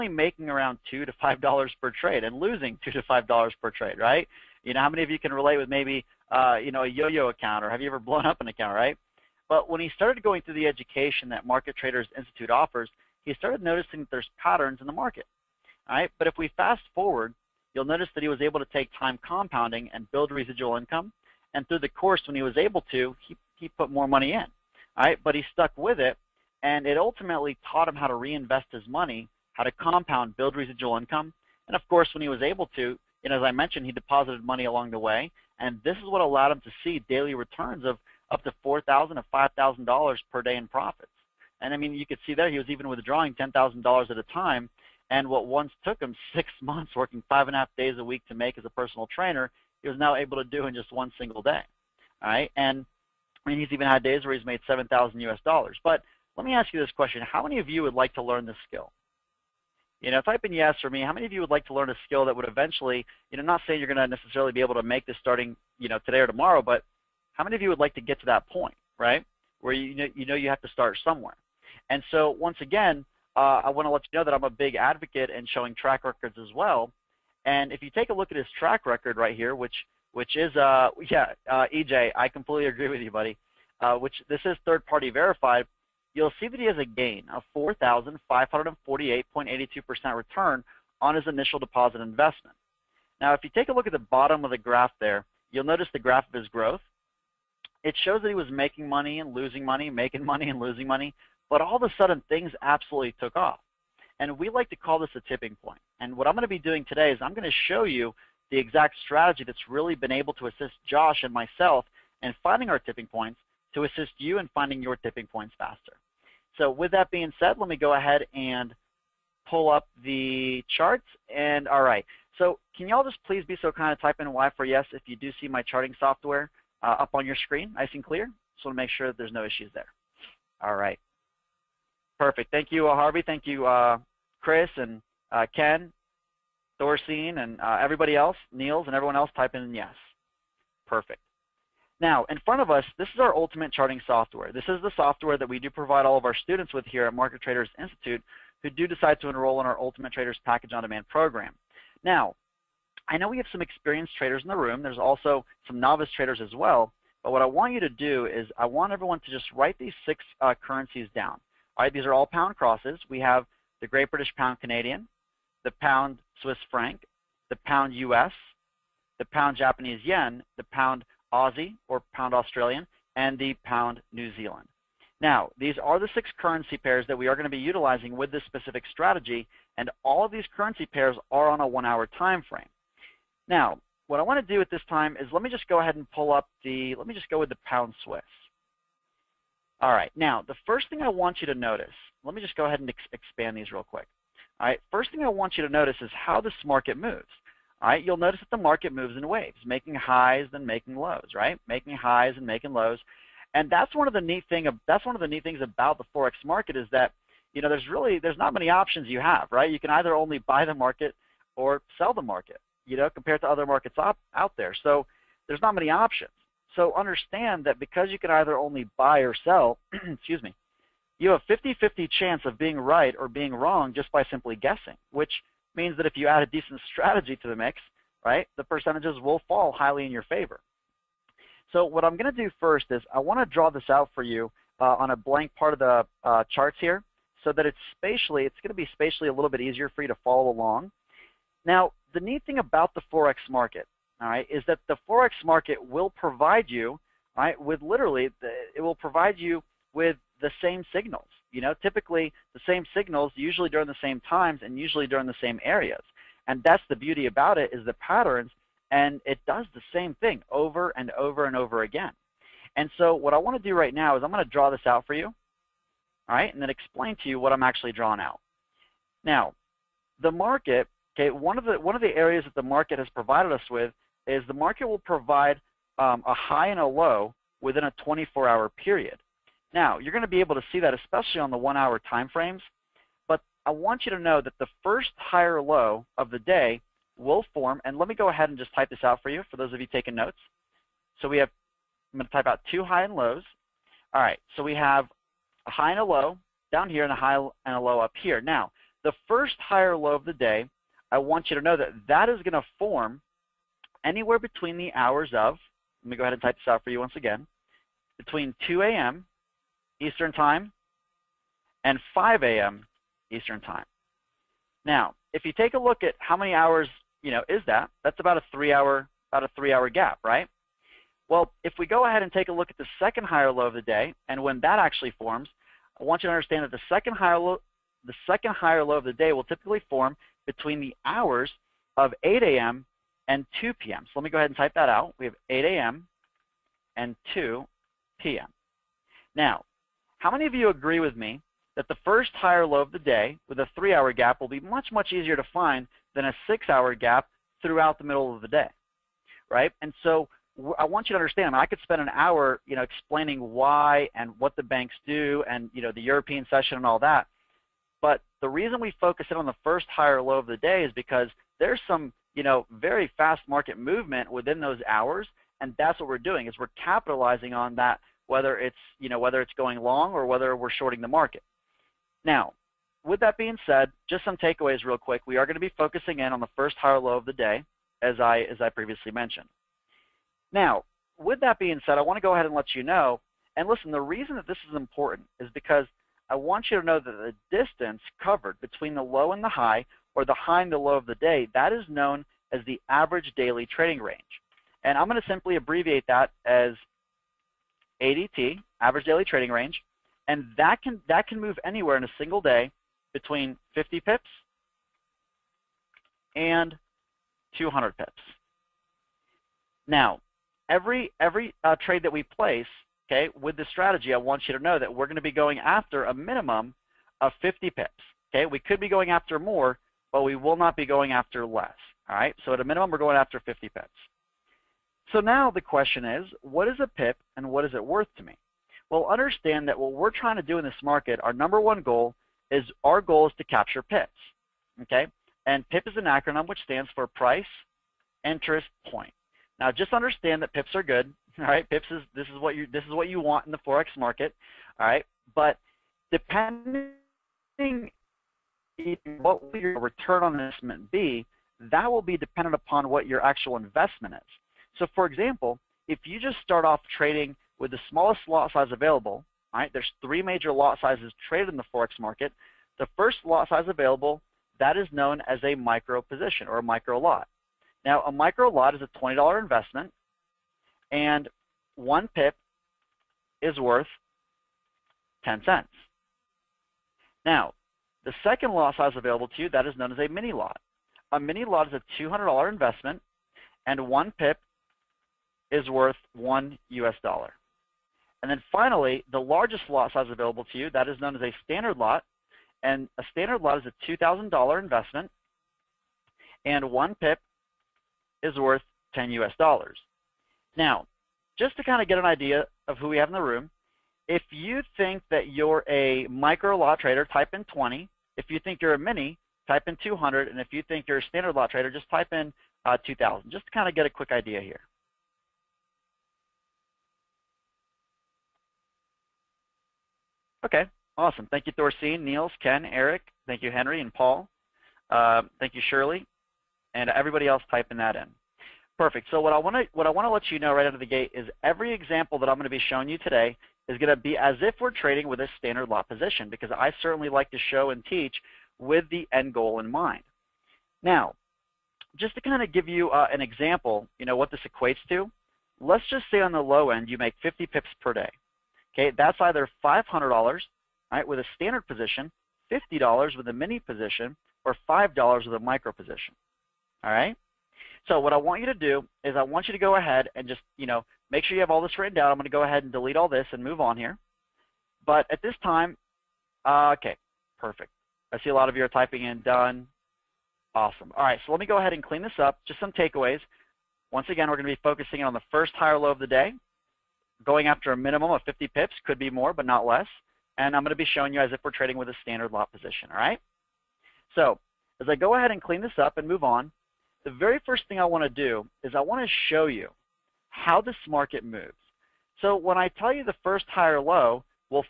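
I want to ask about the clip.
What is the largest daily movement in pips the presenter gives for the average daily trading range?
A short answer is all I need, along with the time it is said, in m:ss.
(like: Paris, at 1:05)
200 pips, at 6:47.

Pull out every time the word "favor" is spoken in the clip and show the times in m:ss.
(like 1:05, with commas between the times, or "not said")
3:50.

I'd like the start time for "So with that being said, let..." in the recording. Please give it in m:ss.
1:56.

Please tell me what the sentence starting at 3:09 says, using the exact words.
All right, now, the first thing I want you to notice, let me just go ahead and ex expand these real quick.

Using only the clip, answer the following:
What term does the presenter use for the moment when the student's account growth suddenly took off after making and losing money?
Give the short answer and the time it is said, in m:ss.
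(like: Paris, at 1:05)
tipping point, at 1:45.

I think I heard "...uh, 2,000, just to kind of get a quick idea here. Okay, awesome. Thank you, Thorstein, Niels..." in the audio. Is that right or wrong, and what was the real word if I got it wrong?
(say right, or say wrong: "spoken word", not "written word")
right.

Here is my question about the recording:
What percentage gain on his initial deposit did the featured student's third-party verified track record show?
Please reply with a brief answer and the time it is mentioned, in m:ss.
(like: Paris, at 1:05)
4,548.82%, at 1:27.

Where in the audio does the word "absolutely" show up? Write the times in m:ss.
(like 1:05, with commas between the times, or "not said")
1:42.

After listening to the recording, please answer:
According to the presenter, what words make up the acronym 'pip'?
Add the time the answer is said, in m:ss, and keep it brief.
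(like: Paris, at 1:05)
price, interest, point, at 7:17.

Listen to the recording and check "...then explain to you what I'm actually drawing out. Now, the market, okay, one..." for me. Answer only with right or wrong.
right.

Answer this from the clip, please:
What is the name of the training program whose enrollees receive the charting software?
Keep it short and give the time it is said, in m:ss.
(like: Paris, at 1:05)
Ultimate Traders Package On Demand, at 2:29.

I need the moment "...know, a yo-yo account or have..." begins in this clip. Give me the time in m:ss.
0:06.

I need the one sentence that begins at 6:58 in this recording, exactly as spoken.
Okay, we could be going after more, but we will not be going after less.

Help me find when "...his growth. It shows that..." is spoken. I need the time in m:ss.
1:36.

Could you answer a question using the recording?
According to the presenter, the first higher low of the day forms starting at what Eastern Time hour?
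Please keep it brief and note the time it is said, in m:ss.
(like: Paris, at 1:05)
2 a.m., at 5:08.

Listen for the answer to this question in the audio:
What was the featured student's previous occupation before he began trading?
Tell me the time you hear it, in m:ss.
0:48.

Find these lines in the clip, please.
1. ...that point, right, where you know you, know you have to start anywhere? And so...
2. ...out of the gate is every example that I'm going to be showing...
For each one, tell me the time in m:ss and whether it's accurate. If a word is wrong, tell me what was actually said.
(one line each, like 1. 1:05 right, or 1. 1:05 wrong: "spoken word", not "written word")
1. 1:08 wrong: "somewhere", not "anywhere"
2. 8:50 right.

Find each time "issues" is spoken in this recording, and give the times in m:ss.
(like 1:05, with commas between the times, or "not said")
2:09.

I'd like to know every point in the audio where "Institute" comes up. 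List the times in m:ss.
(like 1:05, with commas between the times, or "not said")
0:12, 2:27.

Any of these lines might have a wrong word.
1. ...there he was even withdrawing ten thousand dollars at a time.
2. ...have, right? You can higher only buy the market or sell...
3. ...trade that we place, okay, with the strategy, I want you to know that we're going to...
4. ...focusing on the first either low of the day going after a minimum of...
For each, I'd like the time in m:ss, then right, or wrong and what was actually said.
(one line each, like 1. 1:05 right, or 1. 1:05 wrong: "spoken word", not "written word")
1. 0:42 right
2. 3:29 wrong: "either", not "higher"
3. 6:51 right
4. 9:34 wrong: "higher", not "either".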